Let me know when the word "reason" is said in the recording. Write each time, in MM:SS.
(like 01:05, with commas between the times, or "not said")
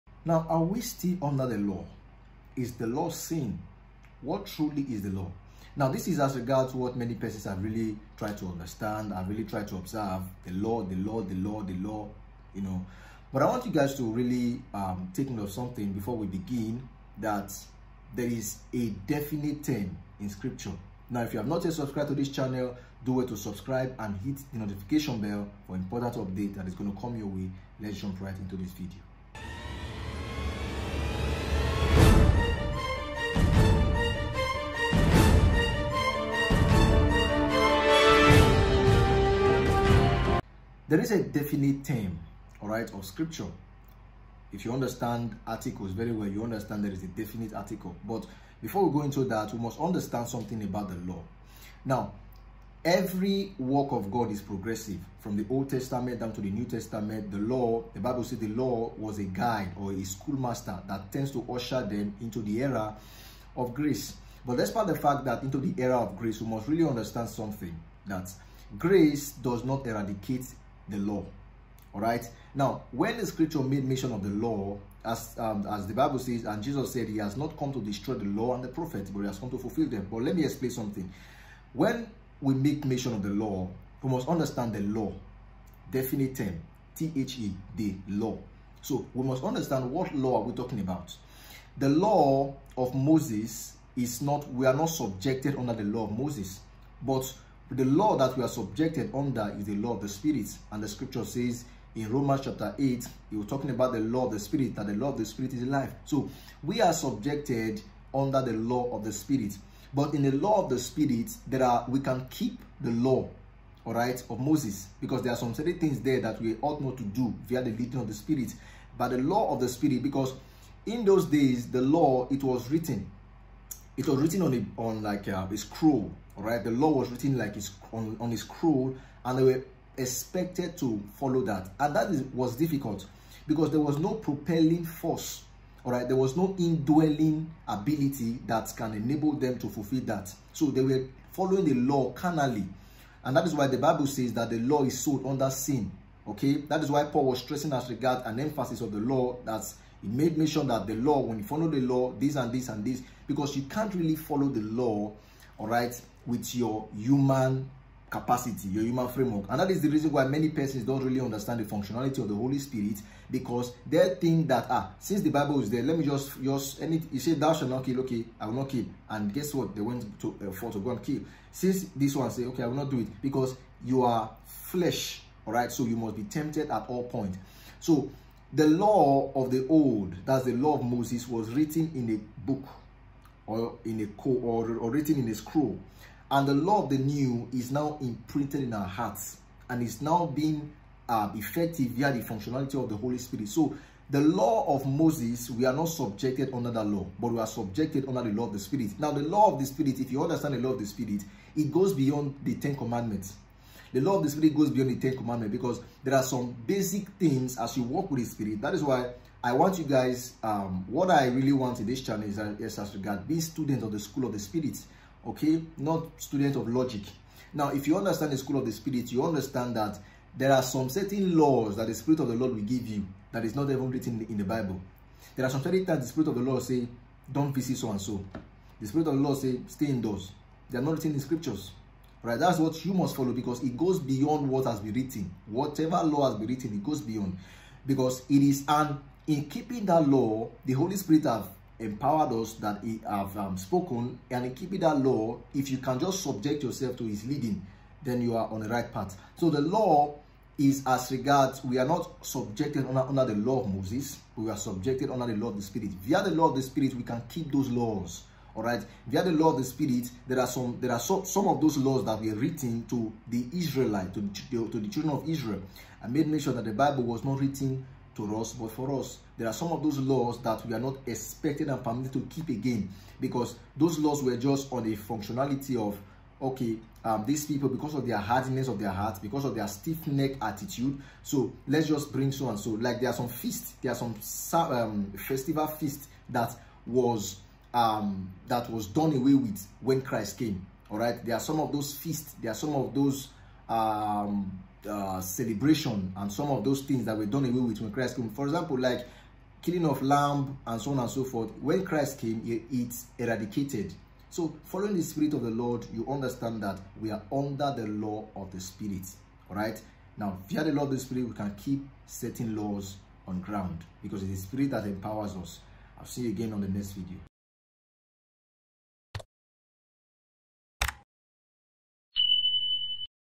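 02:39.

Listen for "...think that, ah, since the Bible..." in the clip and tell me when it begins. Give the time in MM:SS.
02:44.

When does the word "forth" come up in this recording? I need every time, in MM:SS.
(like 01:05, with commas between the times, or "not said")
05:01.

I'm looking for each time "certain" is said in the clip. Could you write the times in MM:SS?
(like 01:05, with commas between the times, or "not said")
01:55, 03:40, 03:45.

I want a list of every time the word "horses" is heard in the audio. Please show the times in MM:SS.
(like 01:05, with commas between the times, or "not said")
not said.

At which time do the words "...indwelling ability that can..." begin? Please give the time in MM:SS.
02:16.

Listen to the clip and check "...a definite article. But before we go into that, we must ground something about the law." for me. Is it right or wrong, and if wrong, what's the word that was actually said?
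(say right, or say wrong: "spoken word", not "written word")
wrong: "understand", not "ground".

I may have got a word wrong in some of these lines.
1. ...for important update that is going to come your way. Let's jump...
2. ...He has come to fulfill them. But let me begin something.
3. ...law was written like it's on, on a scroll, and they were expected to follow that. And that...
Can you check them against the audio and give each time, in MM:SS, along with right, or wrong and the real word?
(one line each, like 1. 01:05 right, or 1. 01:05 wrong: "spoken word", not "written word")
1. 00:25 right
2. 01:19 wrong: "explain", not "begin"
3. 02:06 right.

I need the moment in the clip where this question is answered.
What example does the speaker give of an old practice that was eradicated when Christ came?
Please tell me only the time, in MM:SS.
04:59.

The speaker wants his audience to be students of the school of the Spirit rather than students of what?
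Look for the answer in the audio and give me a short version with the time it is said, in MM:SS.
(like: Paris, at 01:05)
logic, at 03:36.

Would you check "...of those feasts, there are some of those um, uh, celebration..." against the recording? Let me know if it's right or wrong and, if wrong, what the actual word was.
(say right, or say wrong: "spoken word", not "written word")
right.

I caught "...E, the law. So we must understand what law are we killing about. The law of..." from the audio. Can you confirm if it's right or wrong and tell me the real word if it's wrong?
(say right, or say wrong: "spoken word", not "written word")
wrong: "talking", not "killing".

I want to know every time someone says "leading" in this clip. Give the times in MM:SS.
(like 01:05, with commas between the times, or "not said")
01:57, 04:07.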